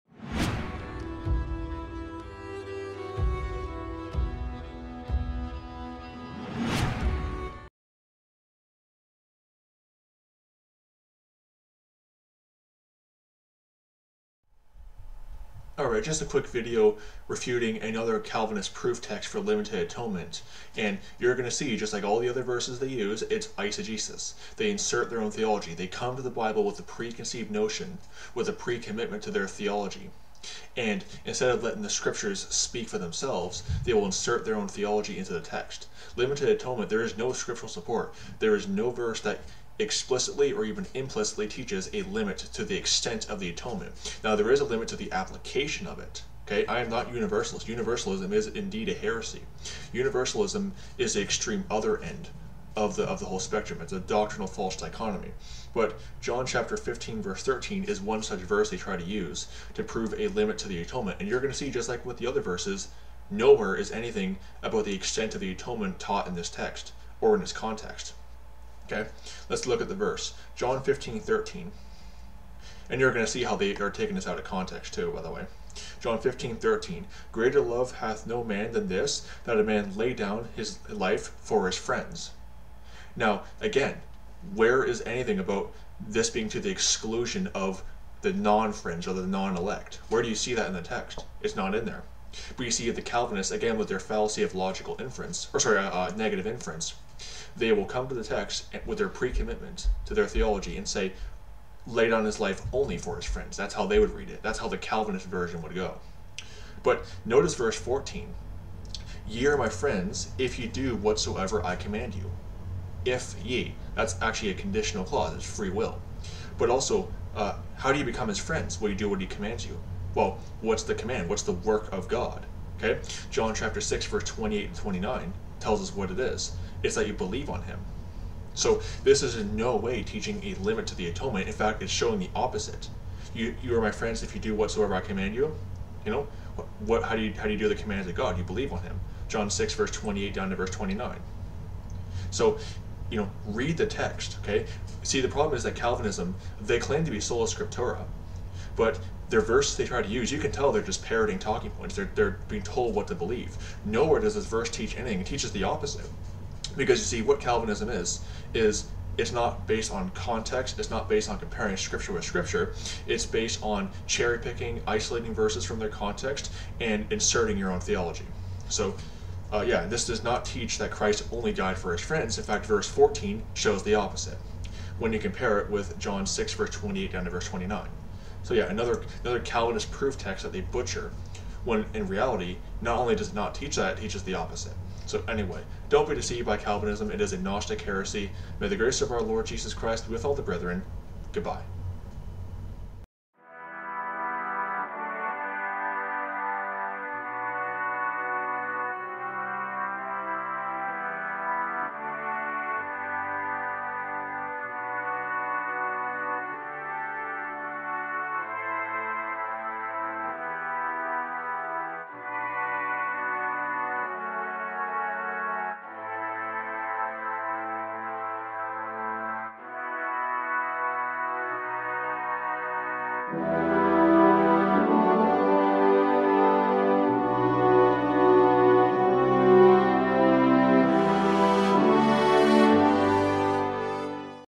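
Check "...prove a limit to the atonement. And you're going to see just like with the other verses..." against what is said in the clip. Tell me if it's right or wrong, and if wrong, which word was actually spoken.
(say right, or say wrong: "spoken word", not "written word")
right.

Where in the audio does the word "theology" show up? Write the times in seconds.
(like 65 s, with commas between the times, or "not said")
25 s, 29 s, 34 s, 100 s, 167 s.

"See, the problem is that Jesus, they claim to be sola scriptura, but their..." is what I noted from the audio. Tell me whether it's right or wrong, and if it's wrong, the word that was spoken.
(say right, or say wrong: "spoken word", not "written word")
wrong: "Calvinism", not "Jesus".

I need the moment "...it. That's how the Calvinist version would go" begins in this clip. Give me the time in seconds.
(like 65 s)
104 s.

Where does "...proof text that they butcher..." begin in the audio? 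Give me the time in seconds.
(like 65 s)
179 s.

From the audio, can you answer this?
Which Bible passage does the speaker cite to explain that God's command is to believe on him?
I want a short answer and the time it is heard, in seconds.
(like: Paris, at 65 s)
John 6:28-29, at 123 s.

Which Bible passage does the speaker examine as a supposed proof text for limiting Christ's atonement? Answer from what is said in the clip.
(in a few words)
John 15:13.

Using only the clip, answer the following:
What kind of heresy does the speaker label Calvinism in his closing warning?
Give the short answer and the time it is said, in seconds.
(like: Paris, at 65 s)
Gnostic heresy, at 187 s.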